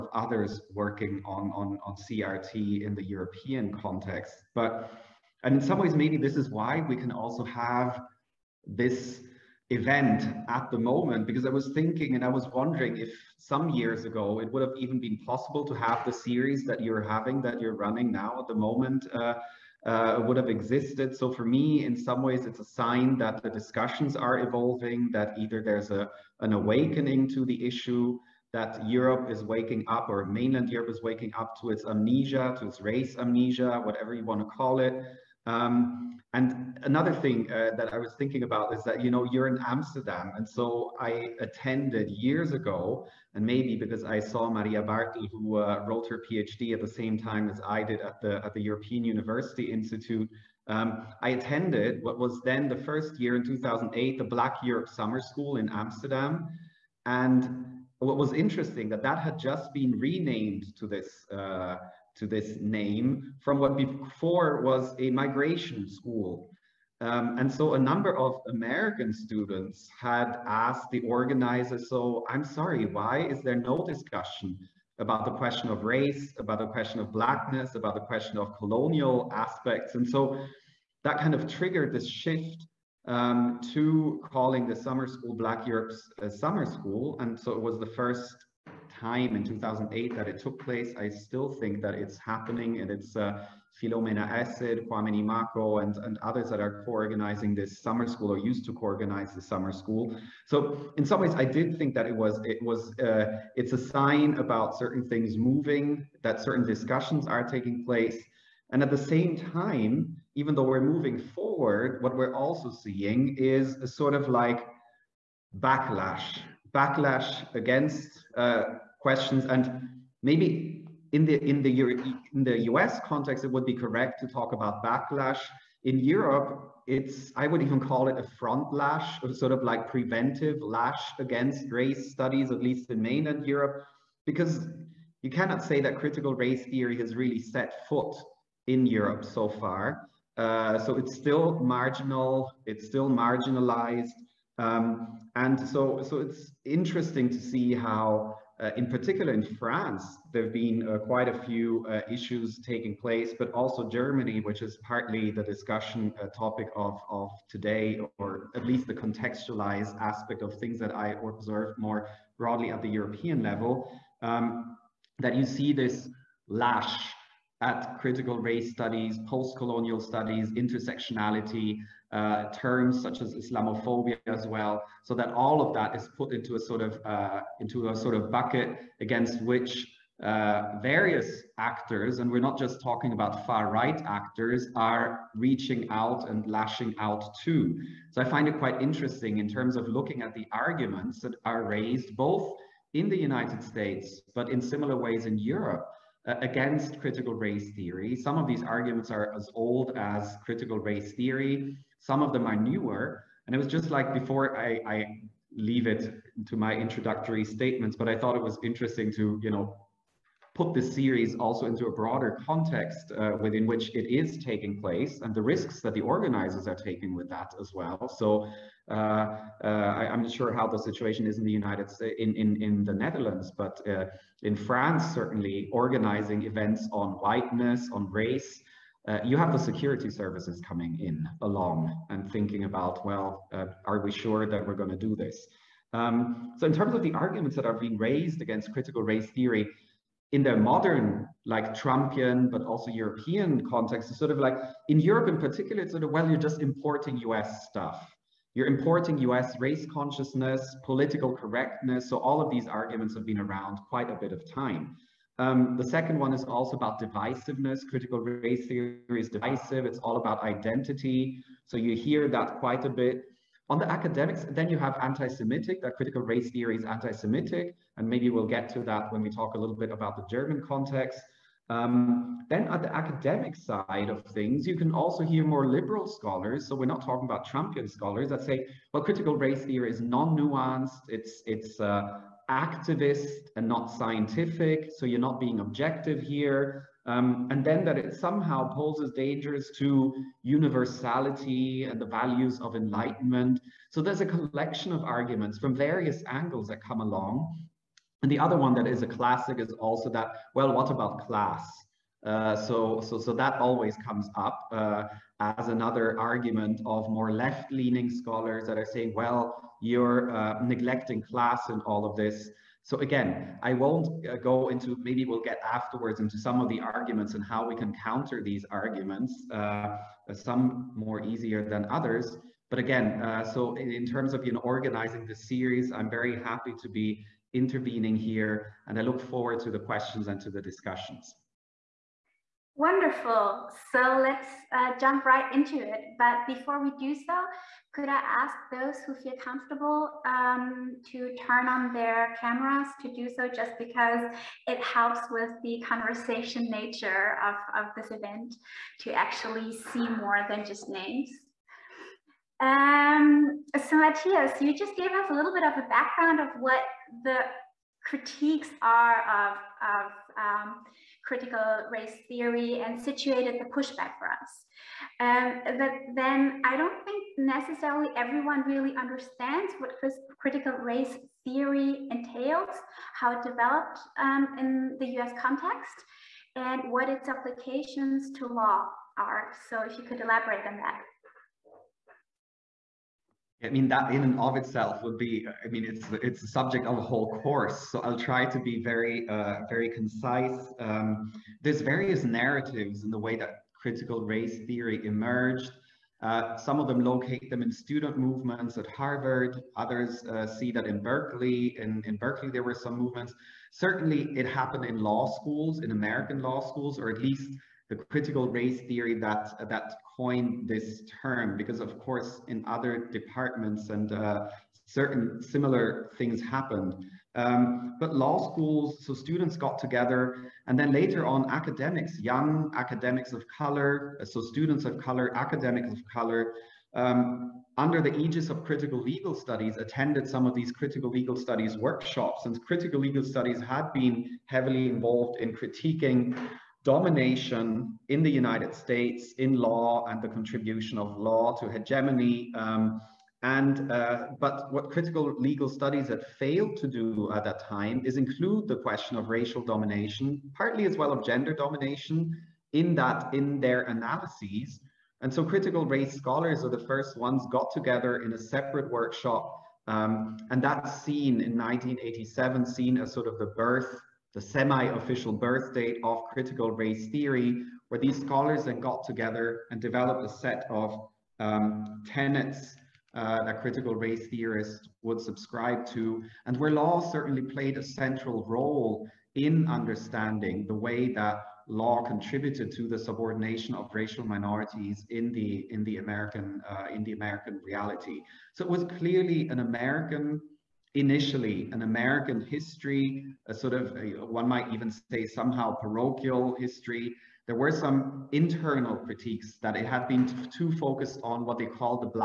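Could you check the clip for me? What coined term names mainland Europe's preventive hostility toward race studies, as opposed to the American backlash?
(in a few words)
front lash.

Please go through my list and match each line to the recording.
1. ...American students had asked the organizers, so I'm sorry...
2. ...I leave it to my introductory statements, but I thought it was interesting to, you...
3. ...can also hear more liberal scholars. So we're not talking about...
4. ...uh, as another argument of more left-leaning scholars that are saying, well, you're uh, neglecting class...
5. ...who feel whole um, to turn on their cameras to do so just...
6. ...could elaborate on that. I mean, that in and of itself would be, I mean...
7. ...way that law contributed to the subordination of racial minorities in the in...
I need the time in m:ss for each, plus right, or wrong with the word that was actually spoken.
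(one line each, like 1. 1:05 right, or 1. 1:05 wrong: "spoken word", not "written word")
1. 1:08 right
2. 3:24 right
3. 4:34 right
4. 5:04 right
5. 5:39 wrong: "comfortable", not "whole"
6. 6:20 right
7. 8:00 right.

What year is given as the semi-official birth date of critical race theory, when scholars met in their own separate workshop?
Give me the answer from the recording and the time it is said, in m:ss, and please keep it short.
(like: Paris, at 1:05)
1987, at 7:41.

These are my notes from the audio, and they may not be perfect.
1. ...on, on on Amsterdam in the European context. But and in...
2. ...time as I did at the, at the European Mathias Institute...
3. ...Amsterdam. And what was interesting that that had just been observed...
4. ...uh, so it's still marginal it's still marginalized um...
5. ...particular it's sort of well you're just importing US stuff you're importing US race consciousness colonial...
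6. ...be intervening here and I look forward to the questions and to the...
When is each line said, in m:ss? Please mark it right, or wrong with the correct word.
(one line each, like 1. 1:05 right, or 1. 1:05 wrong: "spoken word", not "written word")
1. 0:01 wrong: "CRT", not "Amsterdam"
2. 0:47 wrong: "University", not "Mathias"
3. 0:55 wrong: "renamed", not "observed"
4. 2:20 right
5. 4:05 wrong: "political", not "colonial"
6. 5:26 right.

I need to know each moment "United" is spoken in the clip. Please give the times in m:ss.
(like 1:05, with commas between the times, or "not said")
3:13, 3:41, 7:18.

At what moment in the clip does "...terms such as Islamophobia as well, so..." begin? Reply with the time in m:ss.
2:52.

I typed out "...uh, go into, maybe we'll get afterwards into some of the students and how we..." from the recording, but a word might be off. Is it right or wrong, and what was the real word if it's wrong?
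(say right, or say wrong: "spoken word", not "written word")
wrong: "arguments", not "students".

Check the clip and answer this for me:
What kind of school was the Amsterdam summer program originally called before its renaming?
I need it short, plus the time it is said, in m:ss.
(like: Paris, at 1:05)
a migration school, at 1:05.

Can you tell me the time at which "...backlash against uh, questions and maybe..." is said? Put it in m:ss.
1:56.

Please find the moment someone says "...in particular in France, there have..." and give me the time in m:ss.
2:28.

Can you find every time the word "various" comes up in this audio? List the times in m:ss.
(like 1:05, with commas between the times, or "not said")
3:00, 4:55, 6:31.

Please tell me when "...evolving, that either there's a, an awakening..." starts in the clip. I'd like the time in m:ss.
0:24.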